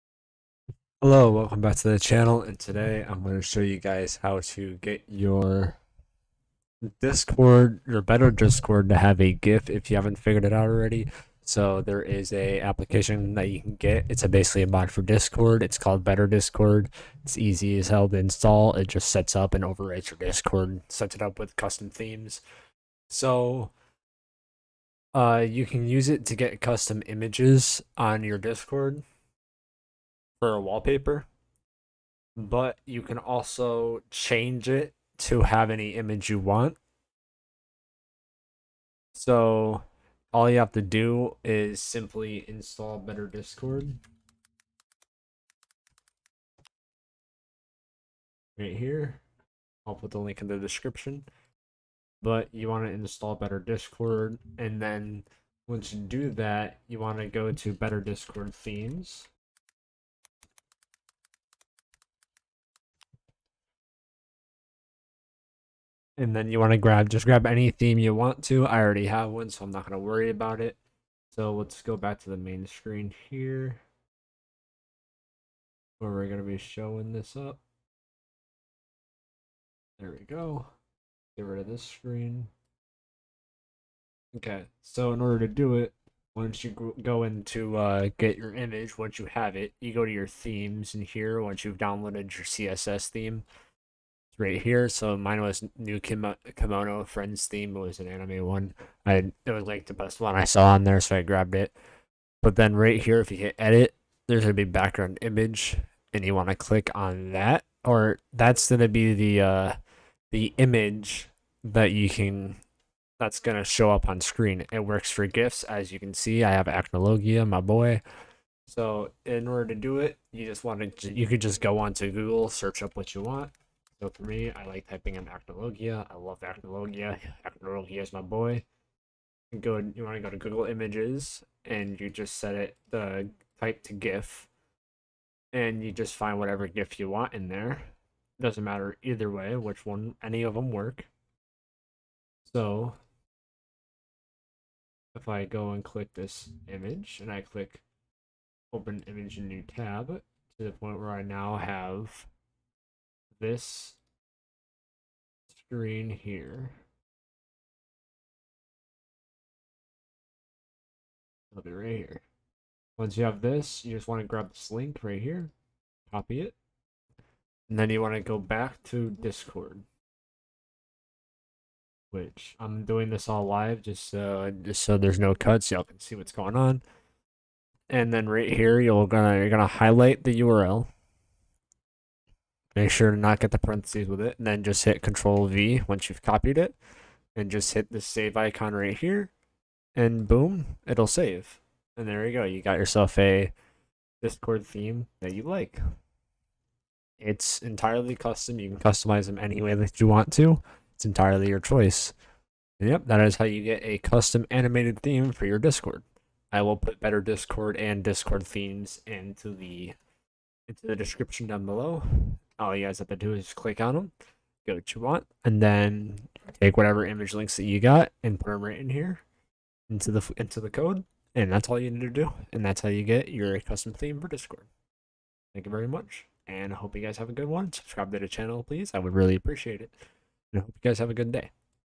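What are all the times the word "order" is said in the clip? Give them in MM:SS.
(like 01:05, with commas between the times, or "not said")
01:25, 01:59.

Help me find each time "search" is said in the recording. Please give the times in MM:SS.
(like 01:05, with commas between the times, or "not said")
02:02.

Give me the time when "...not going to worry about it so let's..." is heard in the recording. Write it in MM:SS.
01:09.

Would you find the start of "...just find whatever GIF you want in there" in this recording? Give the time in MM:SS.
02:15.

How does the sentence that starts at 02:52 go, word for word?
Which I'm doing this all live just so just so there's no cuts, y'all can see what's going on.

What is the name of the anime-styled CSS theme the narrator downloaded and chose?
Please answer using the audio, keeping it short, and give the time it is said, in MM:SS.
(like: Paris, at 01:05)
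Kimono Friends, at 01:36.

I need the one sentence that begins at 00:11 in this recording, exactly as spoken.
So there is a application that you can get.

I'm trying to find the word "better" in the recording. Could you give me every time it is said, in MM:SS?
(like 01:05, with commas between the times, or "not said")
00:08, 00:16, 00:42, 00:53, 00:57, 03:27.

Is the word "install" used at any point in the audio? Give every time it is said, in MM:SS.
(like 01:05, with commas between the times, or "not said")
00:18, 00:42, 00:52.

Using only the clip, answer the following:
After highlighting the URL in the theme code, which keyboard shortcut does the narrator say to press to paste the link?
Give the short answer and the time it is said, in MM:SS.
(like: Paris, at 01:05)
Control V, at 03:05.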